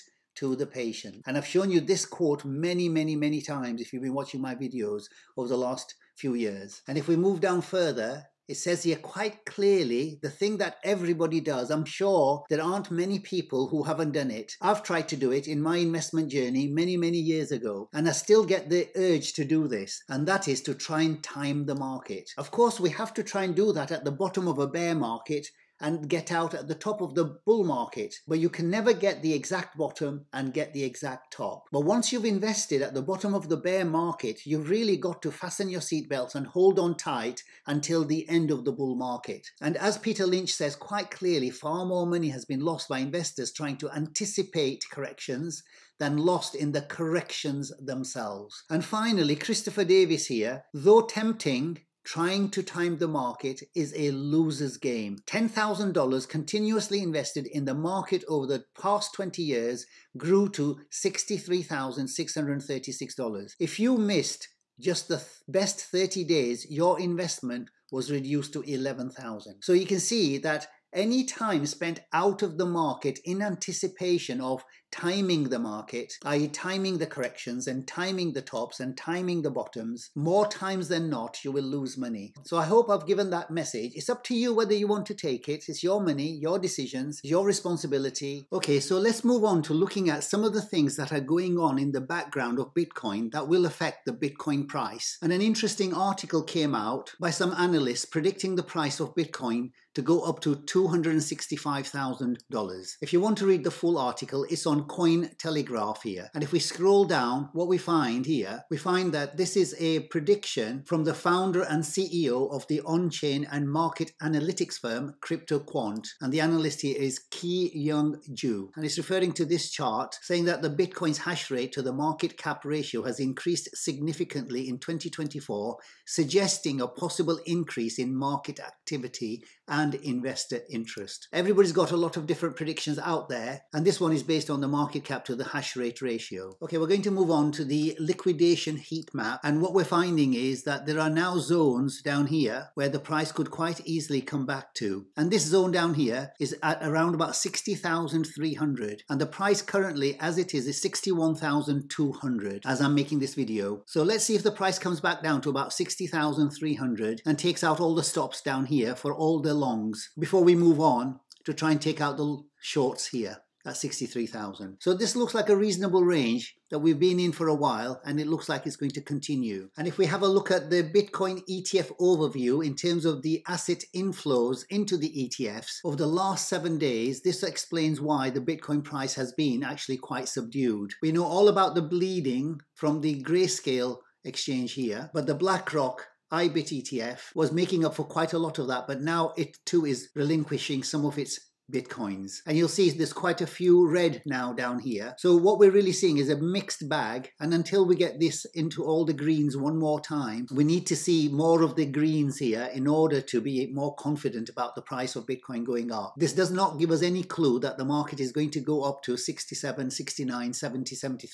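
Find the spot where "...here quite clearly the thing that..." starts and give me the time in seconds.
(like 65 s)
8 s.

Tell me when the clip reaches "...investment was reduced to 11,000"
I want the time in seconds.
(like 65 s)
66 s.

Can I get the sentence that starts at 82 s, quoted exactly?
So I hope I've given that message.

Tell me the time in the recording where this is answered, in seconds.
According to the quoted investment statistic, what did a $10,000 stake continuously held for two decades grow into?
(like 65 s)
60 s.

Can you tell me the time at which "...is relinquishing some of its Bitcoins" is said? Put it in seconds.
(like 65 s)
189 s.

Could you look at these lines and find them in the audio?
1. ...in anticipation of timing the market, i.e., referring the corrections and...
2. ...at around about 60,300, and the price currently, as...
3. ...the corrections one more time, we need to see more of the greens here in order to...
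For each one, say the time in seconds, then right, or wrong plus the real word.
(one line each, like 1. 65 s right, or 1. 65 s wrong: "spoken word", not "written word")
1. 73 s wrong: "timing", not "referring"
2. 146 s right
3. 199 s wrong: "greens", not "corrections".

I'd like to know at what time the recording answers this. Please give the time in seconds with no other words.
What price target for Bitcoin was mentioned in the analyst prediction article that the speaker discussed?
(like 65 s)
100 s.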